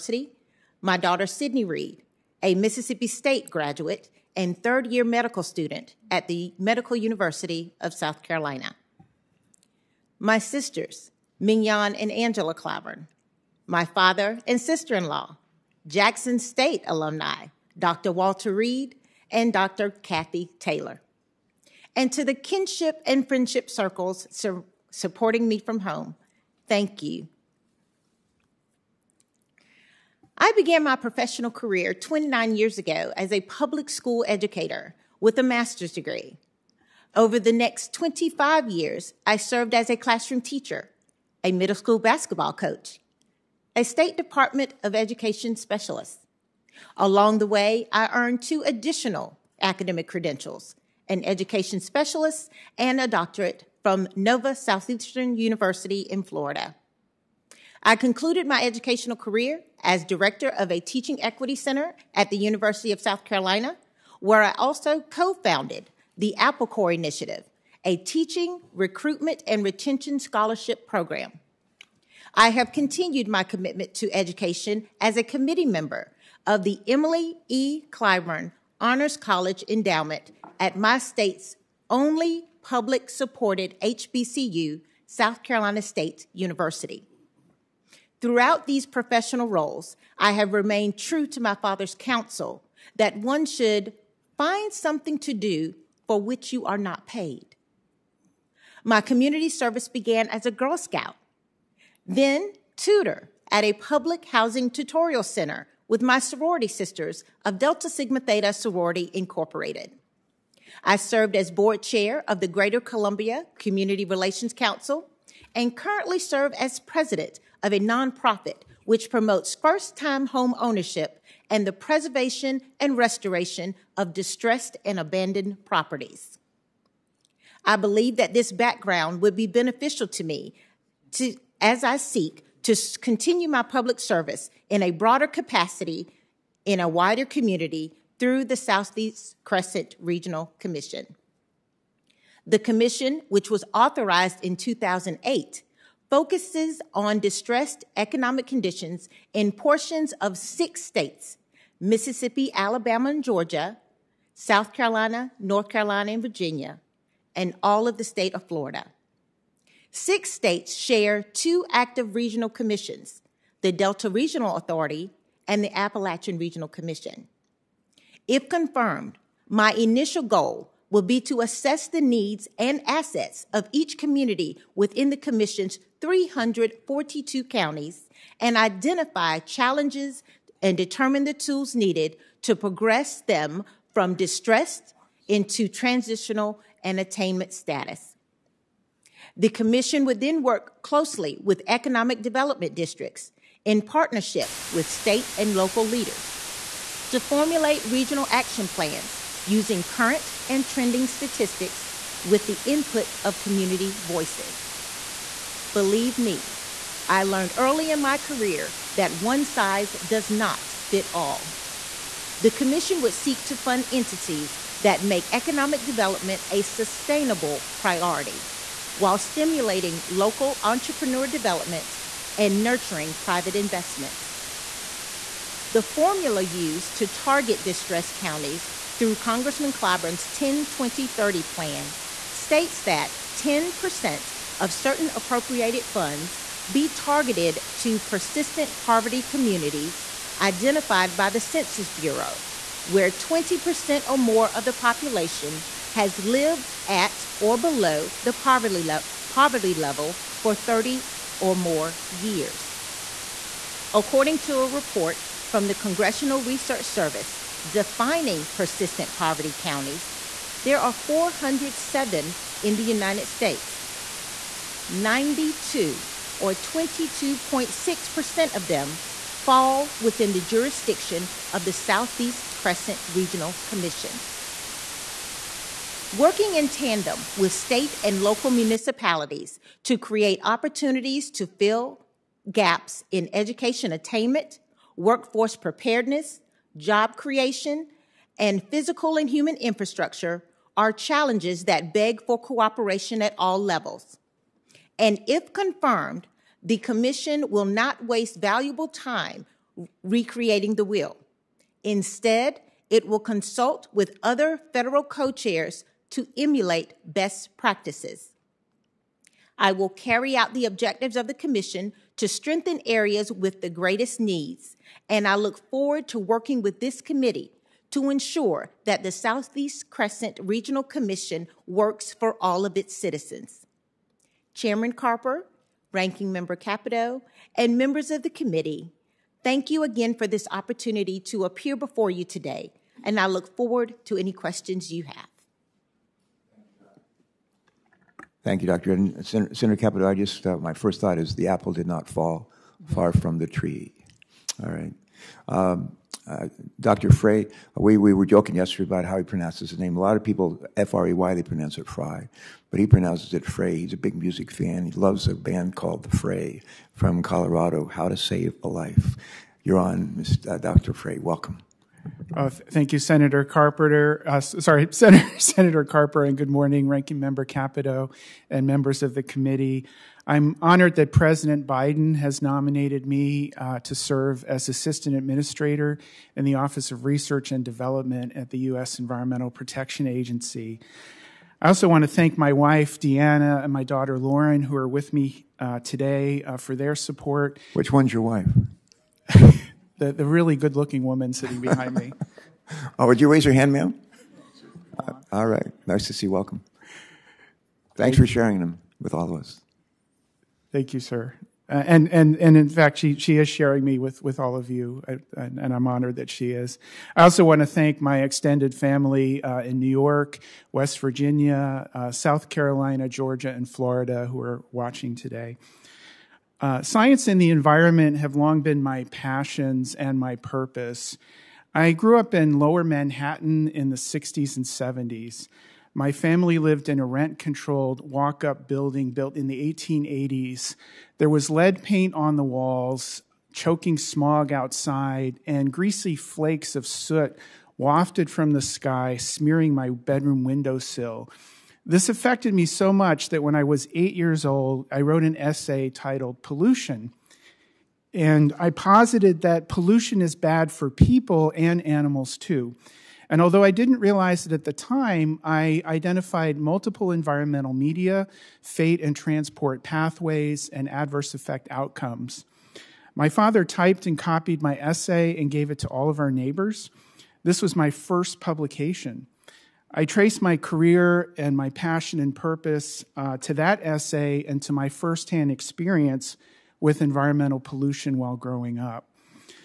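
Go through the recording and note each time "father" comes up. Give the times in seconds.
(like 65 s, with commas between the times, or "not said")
13 s, 91 s, 463 s.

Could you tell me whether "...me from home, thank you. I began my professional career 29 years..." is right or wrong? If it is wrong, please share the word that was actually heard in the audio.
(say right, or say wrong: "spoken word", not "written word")
right.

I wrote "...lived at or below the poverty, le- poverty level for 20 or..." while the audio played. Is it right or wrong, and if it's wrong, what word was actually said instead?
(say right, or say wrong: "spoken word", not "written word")
wrong: "30", not "20".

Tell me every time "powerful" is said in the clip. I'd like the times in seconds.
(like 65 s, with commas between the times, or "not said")
not said.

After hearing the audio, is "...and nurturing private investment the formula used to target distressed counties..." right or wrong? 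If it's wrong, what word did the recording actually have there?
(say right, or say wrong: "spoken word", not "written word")
right.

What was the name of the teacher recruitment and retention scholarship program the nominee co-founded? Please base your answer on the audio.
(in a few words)
Apple Corps Initiative.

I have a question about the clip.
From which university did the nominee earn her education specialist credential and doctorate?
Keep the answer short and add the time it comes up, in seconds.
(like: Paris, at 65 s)
Nova Southeastern University, at 54 s.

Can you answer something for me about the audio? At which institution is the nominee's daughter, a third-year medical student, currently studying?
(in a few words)
Medical University of South Carolina.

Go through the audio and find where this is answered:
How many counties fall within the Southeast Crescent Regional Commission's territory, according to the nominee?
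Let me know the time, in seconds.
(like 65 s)
176 s.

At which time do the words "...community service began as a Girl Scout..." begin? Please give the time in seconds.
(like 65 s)
99 s.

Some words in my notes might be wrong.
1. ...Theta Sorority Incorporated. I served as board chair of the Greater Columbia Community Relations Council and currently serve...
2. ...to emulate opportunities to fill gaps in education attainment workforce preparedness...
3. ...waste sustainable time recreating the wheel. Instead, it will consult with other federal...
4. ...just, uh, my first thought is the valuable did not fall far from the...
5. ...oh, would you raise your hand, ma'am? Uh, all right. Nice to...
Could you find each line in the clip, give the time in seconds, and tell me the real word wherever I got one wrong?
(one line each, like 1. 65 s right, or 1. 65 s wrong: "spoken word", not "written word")
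1. 108 s right
2. 279 s wrong: "create", not "emulate"
3. 298 s wrong: "valuable", not "sustainable"
4. 340 s wrong: "apple", not "valuable"
5. 392 s right.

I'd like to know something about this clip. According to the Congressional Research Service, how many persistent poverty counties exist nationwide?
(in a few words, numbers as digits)
407.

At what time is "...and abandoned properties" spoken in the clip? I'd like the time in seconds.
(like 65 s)
124 s.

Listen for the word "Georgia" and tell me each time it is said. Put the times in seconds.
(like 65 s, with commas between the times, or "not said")
153 s, 413 s.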